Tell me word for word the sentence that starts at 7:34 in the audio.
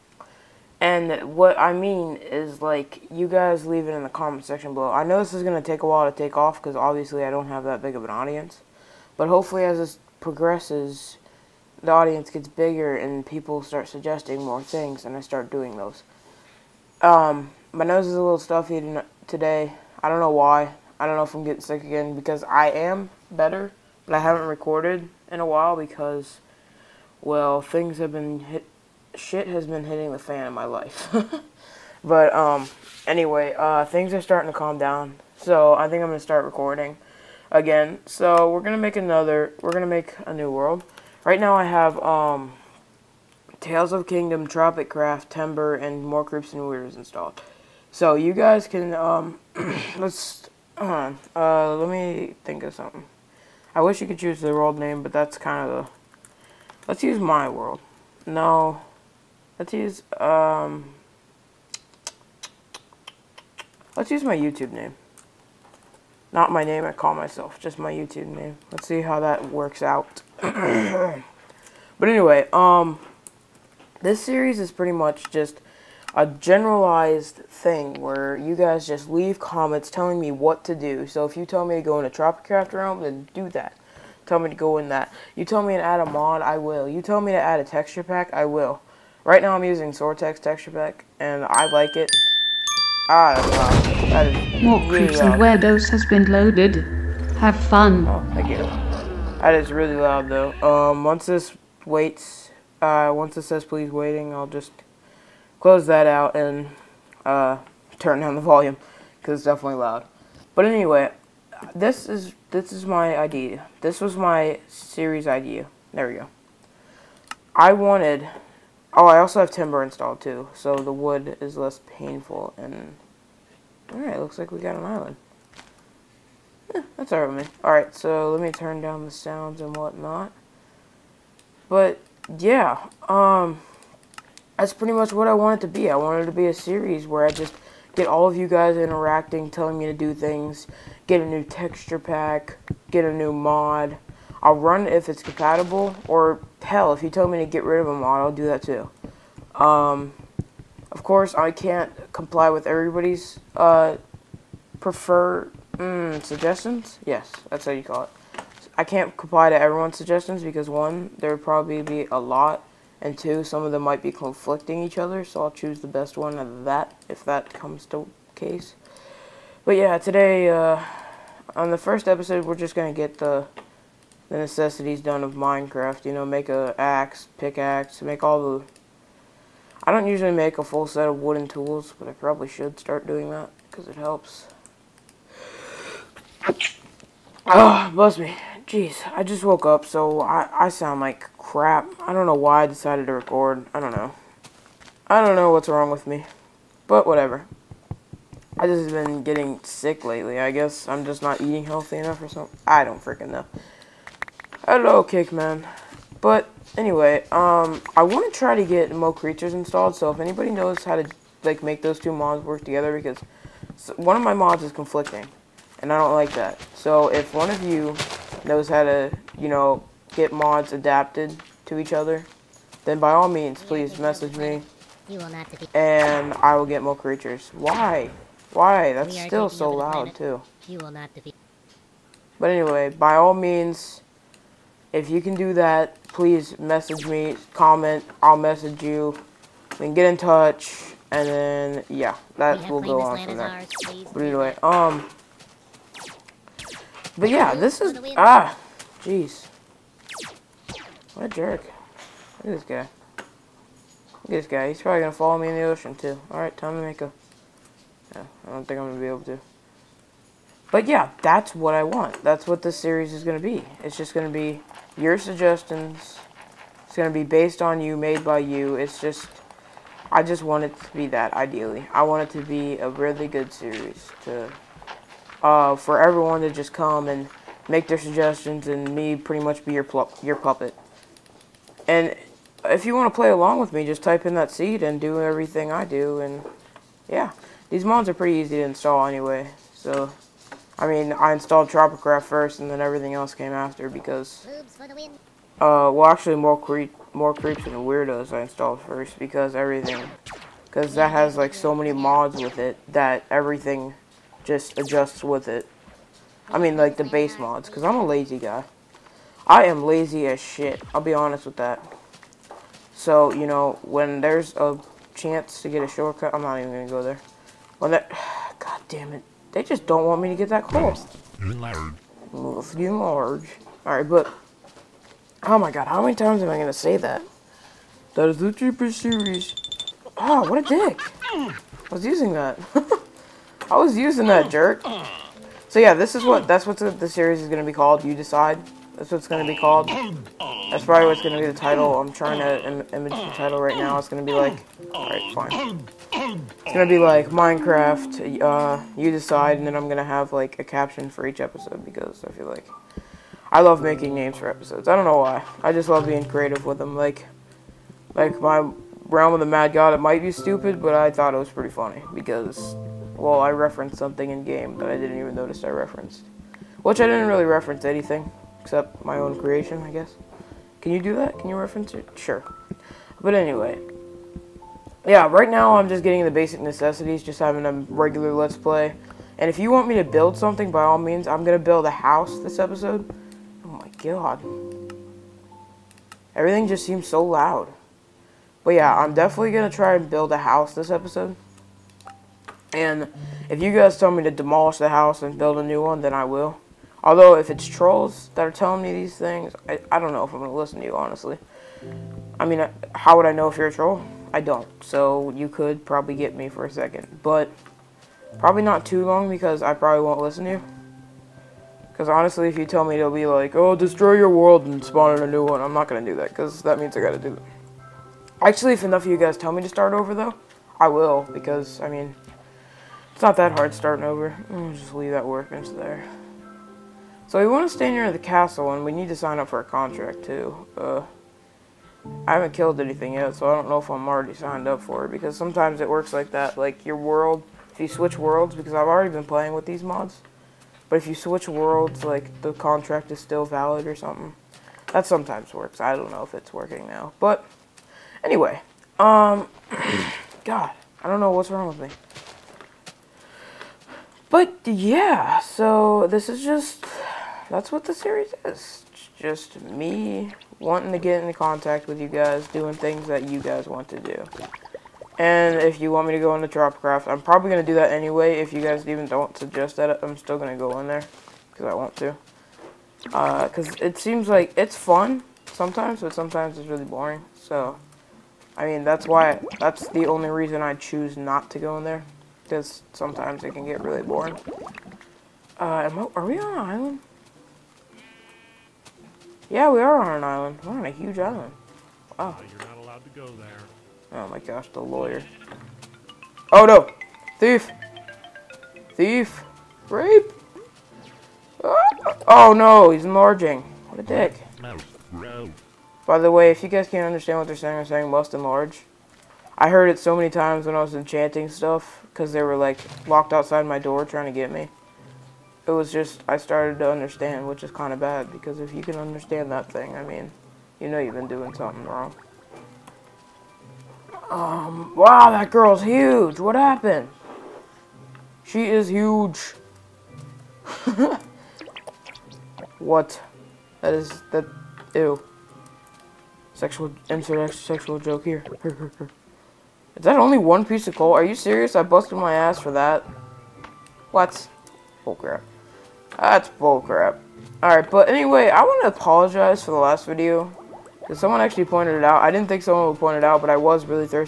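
But yeah, so this is just that's what the series is.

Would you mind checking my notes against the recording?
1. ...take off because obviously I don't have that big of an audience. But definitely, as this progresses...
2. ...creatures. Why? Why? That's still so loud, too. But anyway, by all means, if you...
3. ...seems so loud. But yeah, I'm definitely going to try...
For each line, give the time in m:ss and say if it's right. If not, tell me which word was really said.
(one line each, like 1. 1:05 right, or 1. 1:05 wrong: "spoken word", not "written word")
1. 0:06 wrong: "hopefully", not "definitely"
2. 3:46 right
3. 6:26 right.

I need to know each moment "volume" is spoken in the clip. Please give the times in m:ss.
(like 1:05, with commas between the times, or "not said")
1:48.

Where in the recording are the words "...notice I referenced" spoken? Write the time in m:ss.
6:05.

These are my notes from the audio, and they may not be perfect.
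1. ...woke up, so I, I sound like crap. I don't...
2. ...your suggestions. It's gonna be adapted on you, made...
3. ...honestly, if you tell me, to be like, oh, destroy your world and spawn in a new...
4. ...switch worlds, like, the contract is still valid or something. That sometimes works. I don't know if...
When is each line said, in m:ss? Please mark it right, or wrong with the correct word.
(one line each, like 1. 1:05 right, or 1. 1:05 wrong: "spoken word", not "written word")
1. 3:09 right
2. 4:24 wrong: "based", not "adapted"
3. 6:52 right
4. 7:21 right.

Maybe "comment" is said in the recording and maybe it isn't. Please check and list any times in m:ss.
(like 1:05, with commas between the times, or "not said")
0:04, 1:19, 3:57.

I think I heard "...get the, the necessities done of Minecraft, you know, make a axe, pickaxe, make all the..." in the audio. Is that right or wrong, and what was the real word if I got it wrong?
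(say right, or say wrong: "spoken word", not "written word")
right.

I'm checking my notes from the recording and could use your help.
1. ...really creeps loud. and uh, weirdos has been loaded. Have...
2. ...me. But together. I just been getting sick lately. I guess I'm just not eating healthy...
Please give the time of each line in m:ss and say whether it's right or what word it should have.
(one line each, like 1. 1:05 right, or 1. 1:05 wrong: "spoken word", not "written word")
1. 1:34 right
2. 3:16 wrong: "whatever", not "together".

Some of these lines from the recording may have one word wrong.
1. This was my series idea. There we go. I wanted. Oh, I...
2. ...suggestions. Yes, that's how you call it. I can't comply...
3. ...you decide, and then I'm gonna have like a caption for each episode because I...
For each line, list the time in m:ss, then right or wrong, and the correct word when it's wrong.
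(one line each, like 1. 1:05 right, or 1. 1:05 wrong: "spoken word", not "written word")
1. 1:53 right
2. 2:36 right
3. 5:49 right.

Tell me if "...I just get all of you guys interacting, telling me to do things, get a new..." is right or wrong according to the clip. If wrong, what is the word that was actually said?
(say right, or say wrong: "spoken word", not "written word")
right.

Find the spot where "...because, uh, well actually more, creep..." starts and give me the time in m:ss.
4:53.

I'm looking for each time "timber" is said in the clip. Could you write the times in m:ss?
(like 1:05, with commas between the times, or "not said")
0:45, 1:59.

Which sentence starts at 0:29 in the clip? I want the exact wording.
Shit has been hitting the fan in my life.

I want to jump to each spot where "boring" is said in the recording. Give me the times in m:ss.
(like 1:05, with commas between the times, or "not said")
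7:56, 8:04.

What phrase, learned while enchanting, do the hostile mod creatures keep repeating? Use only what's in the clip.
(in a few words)
Must enlarge.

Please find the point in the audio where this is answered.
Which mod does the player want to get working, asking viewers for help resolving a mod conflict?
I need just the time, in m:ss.
3:28.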